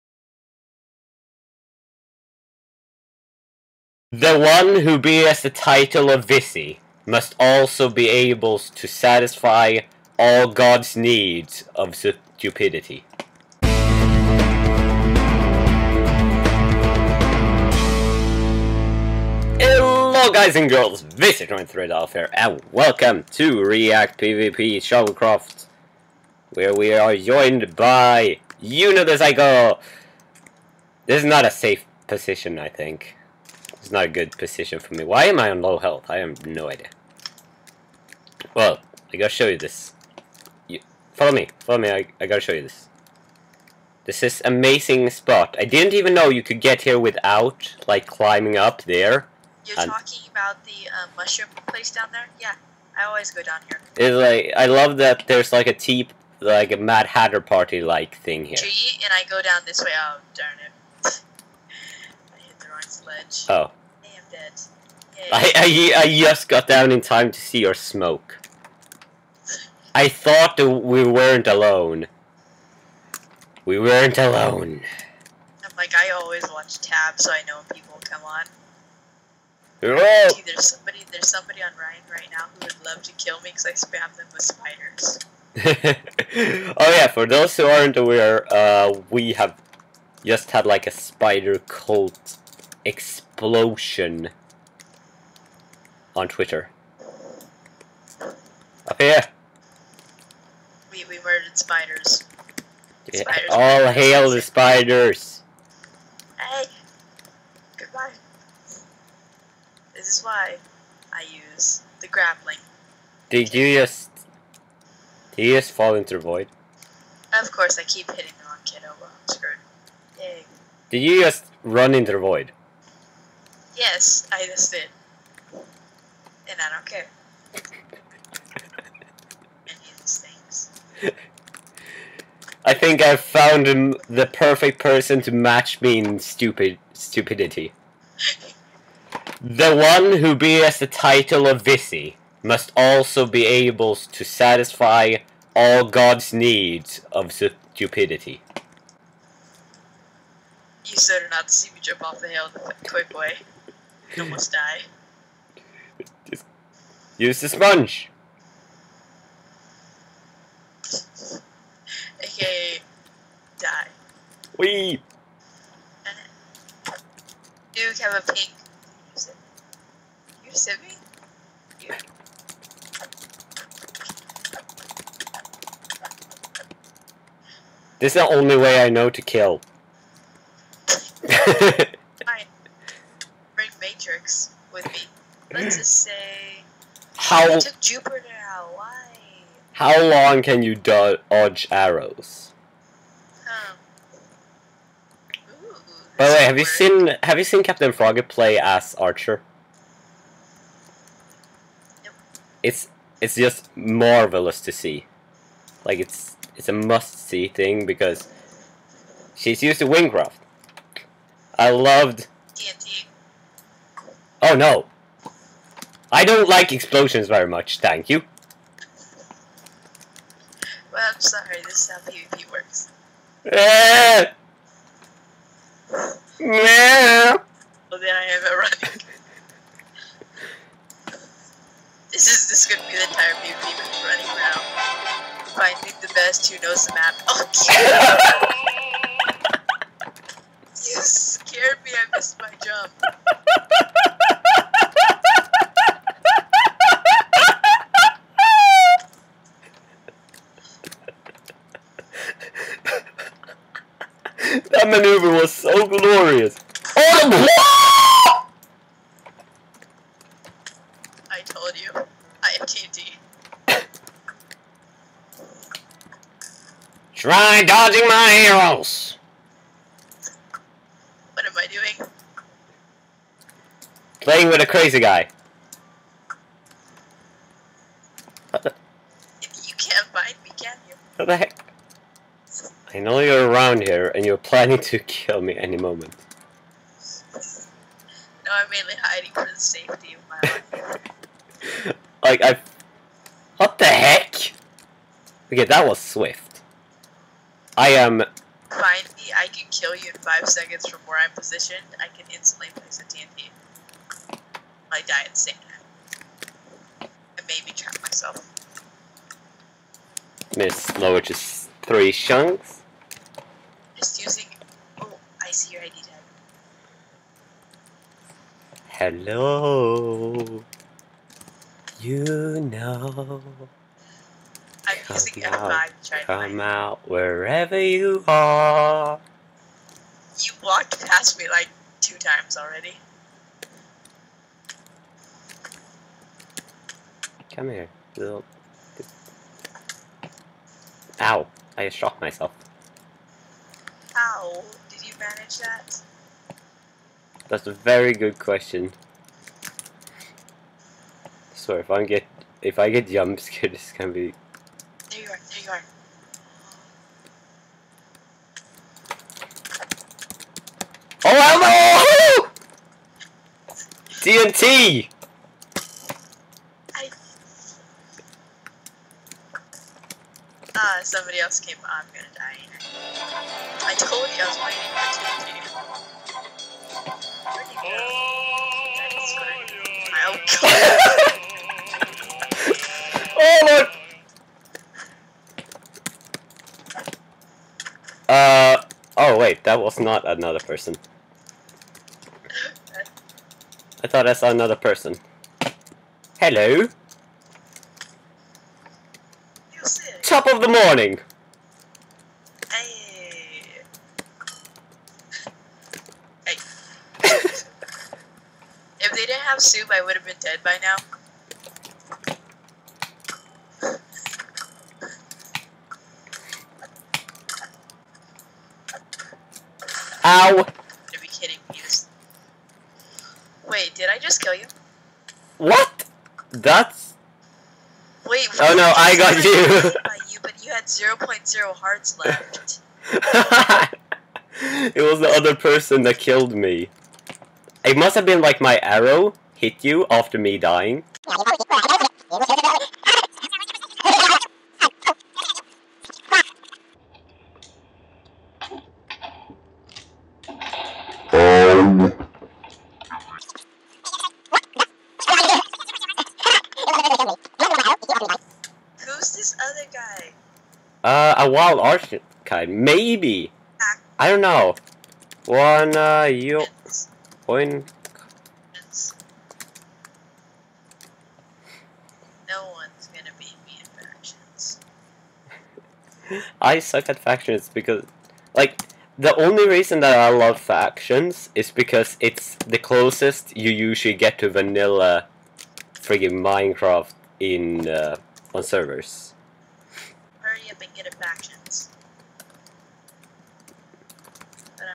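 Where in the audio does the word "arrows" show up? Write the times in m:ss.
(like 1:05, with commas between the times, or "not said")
3:11, 4:28, 7:18.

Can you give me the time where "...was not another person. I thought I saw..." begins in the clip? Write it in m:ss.
6:29.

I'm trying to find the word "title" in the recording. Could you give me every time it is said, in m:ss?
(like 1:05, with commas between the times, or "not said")
0:05, 2:20.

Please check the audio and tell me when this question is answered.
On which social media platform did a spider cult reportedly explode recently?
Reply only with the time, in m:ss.
1:36.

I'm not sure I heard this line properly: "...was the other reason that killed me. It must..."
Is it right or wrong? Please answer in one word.
wrong.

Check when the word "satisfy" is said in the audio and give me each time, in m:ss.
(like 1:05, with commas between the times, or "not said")
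0:08, 2:24.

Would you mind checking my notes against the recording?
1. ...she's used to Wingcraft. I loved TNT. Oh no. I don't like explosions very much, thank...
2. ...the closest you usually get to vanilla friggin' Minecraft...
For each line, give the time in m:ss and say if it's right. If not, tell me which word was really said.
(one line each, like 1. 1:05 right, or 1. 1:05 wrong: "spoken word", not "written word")
1. 3:29 right
2. 8:02 right.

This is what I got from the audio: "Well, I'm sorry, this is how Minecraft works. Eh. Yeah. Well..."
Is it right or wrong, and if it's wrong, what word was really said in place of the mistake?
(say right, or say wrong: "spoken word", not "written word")
wrong: "PvP", not "Minecraft".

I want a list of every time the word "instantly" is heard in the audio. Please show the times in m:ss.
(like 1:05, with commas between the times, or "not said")
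5:02.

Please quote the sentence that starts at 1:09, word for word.
I thought that we weren't alone.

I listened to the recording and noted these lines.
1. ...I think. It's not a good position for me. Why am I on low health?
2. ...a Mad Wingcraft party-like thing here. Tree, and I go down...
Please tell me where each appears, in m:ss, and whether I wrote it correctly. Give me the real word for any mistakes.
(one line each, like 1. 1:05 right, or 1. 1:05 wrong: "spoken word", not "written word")
1. 0:32 right
2. 0:56 wrong: "Hatter", not "Wingcraft".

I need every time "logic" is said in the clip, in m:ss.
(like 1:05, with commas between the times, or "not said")
not said.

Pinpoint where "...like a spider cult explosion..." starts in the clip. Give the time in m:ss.
1:30.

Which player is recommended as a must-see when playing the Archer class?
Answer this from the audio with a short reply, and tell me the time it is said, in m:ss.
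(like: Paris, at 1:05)
Captain Frog, at 3:17.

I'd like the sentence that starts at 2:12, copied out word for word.
I think I've found the perfect person to match me in stupid stupidity.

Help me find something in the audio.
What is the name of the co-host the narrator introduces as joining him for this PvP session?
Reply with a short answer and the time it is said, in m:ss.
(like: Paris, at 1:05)
Yuno the Psycho, at 0:28.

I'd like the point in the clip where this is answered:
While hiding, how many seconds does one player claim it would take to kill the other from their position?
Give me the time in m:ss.
5:00.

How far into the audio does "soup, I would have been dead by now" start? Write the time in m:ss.
6:49.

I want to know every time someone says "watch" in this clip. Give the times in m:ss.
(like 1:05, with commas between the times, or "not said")
1:16.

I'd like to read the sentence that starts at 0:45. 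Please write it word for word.
I didn't even know you could get here without, like, climbing up there.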